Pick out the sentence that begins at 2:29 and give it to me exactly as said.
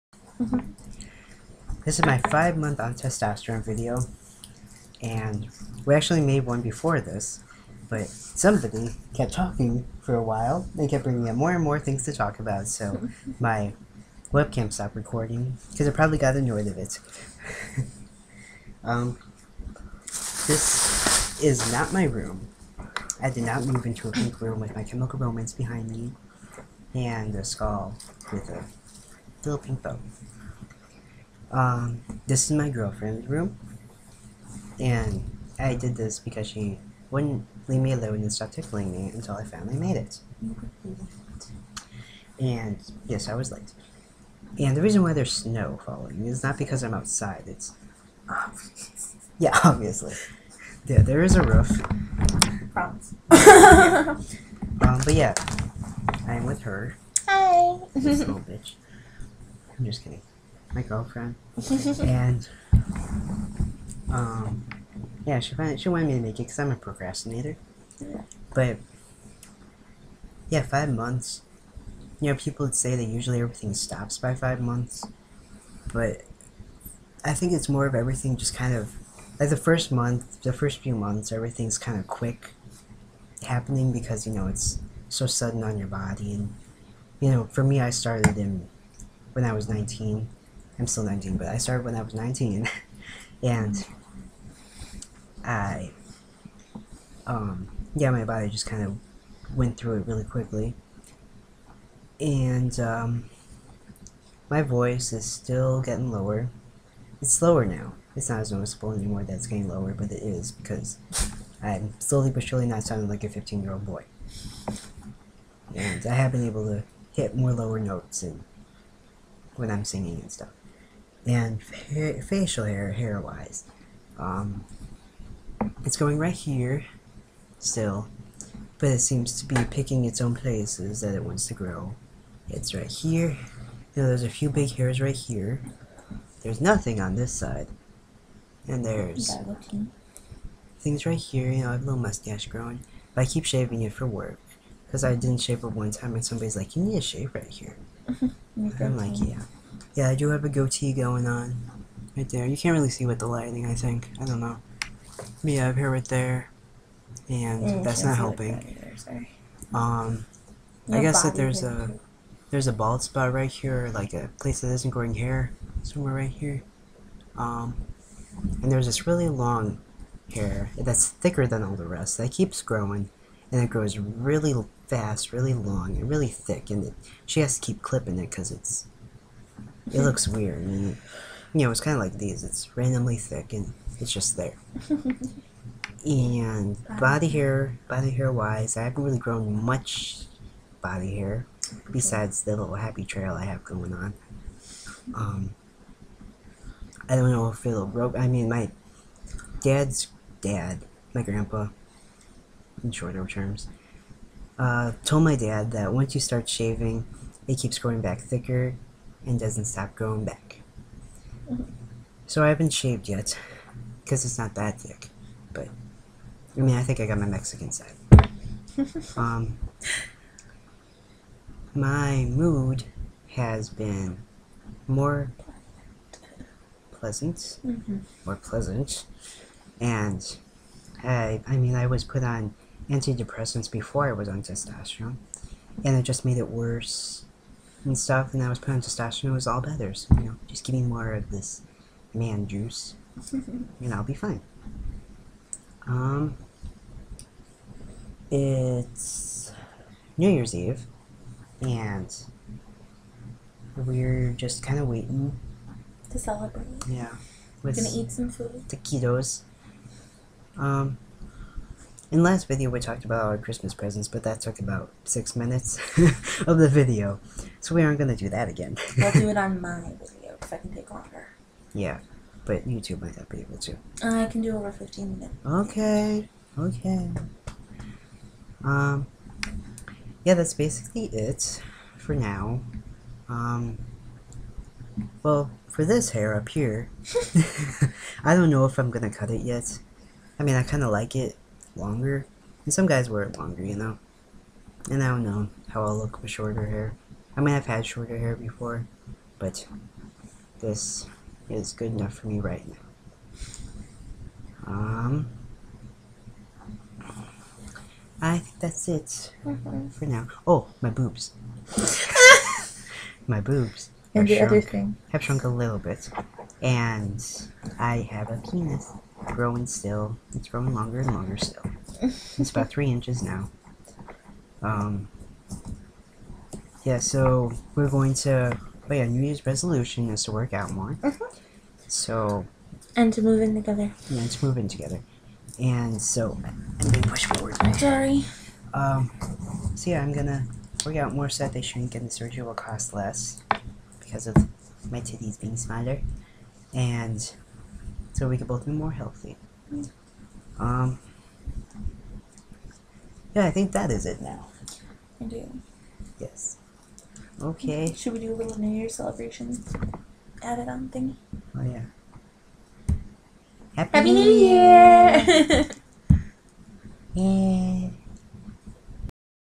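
yeah, I do have a goatee going on.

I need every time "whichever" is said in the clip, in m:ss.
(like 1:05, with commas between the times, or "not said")
not said.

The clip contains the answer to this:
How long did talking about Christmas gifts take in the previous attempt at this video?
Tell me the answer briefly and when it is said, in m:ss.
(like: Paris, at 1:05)
6 minutes, at 4:25.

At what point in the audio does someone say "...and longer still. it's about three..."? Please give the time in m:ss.
5:20.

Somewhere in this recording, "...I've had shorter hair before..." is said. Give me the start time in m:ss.
4:57.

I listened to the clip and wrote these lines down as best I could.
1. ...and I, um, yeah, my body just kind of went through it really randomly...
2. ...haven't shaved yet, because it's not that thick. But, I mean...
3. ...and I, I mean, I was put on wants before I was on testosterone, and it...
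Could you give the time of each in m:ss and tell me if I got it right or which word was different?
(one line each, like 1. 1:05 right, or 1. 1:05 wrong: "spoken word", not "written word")
1. 1:33 wrong: "quickly", not "randomly"
2. 3:32 right
3. 3:49 wrong: "antidepressants", not "wants".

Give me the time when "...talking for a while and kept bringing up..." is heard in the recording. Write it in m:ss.
0:09.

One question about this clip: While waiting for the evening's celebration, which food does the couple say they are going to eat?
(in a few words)
Taquitos.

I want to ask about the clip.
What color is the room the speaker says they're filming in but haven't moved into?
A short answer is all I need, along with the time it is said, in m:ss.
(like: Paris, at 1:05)
Pink, at 0:24.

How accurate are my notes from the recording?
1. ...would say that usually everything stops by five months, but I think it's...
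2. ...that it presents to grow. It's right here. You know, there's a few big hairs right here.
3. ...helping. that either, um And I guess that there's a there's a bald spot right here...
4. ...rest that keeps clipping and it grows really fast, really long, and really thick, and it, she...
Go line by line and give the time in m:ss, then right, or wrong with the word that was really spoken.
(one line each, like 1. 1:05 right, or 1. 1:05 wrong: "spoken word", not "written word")
1. 1:12 right
2. 2:11 wrong: "wants", not "presents"
3. 2:38 wrong: "Your", not "And"
4. 2:51 wrong: "growing", not "clipping".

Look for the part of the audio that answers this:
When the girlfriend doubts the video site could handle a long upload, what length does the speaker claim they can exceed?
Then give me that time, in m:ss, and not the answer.
4:34.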